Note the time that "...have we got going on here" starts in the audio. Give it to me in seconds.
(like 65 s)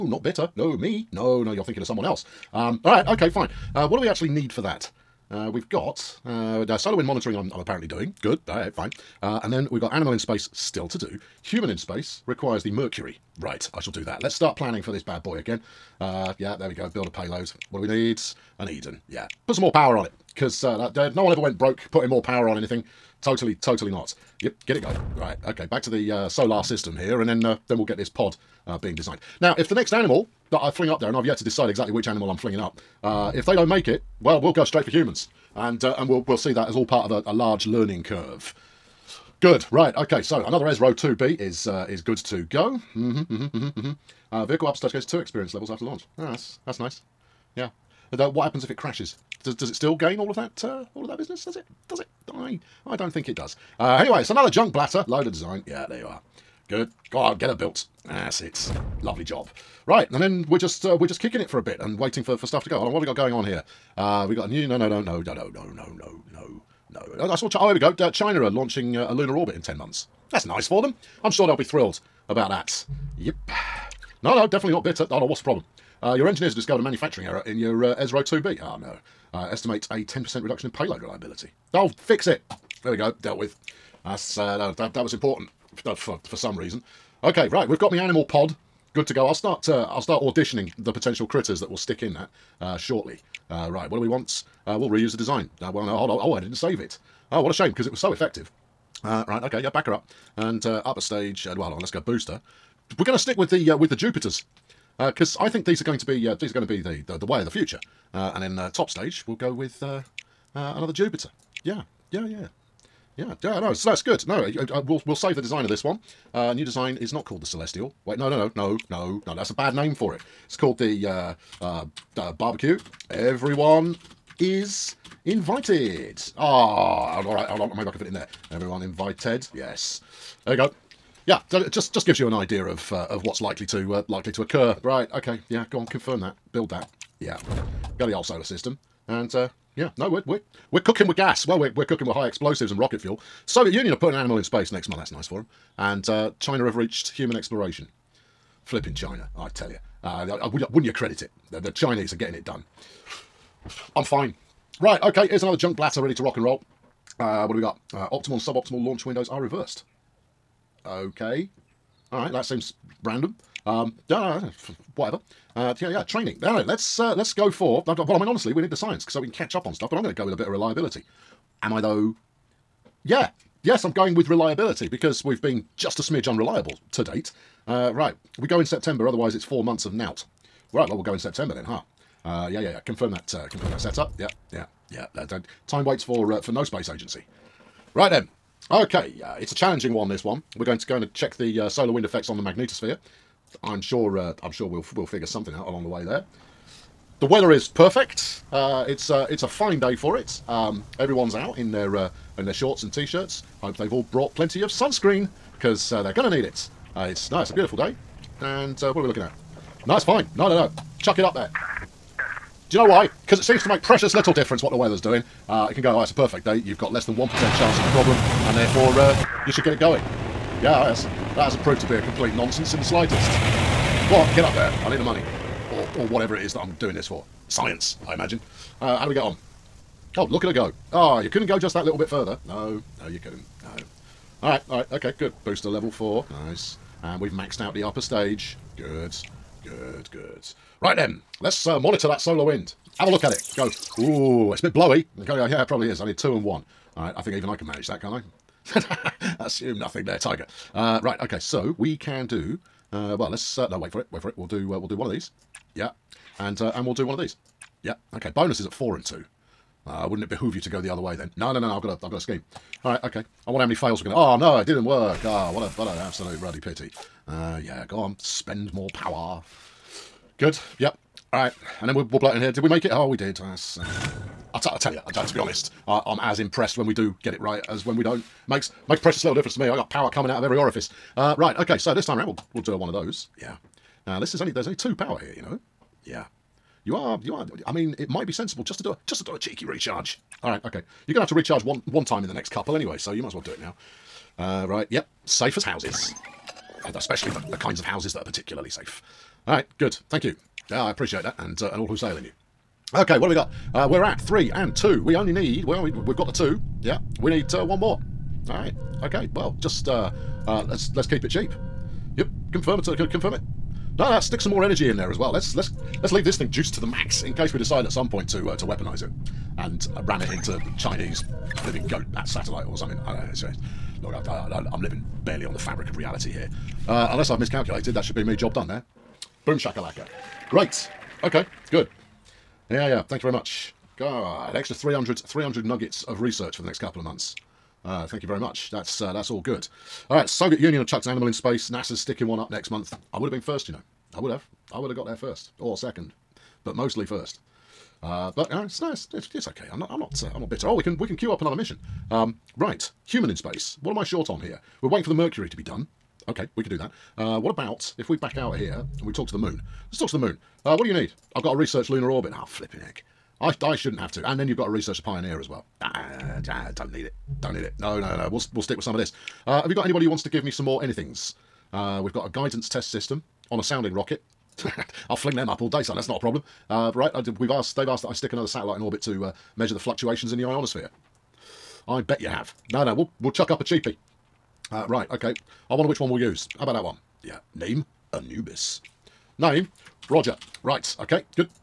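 62 s.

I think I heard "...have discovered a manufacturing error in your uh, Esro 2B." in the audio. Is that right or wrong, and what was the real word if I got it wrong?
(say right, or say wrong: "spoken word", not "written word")
right.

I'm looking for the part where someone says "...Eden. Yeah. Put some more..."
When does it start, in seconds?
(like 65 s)
18 s.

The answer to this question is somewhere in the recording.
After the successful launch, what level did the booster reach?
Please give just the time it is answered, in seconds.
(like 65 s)
235 s.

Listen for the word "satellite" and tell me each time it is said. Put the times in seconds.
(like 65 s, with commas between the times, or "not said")
322 s, 378 s.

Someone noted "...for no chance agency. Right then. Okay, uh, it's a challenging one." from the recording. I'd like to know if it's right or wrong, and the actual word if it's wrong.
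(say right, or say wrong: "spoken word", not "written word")
wrong: "space", not "chance".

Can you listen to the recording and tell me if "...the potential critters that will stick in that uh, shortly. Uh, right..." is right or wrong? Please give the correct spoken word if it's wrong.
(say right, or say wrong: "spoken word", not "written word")
right.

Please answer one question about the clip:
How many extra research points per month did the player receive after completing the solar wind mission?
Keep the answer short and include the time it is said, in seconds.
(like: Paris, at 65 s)
300, at 335 s.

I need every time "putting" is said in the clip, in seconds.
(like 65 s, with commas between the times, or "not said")
21 s, 143 s.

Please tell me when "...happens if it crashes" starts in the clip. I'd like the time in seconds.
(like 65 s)
48 s.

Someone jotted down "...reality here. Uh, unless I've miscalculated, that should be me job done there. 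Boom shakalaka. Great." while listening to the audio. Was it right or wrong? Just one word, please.
right.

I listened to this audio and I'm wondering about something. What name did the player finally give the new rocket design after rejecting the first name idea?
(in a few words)
the barbecue.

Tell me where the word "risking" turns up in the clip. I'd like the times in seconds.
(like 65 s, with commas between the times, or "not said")
not said.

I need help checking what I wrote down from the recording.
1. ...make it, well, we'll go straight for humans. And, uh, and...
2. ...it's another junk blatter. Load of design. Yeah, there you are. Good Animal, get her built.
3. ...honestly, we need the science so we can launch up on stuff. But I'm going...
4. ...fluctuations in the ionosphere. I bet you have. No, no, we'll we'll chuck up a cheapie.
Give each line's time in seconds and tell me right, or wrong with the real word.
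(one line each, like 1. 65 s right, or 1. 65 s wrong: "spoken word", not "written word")
1. 33 s right
2. 54 s wrong: "God", not "Animal"
3. 168 s wrong: "catch", not "launch"
4. 379 s right.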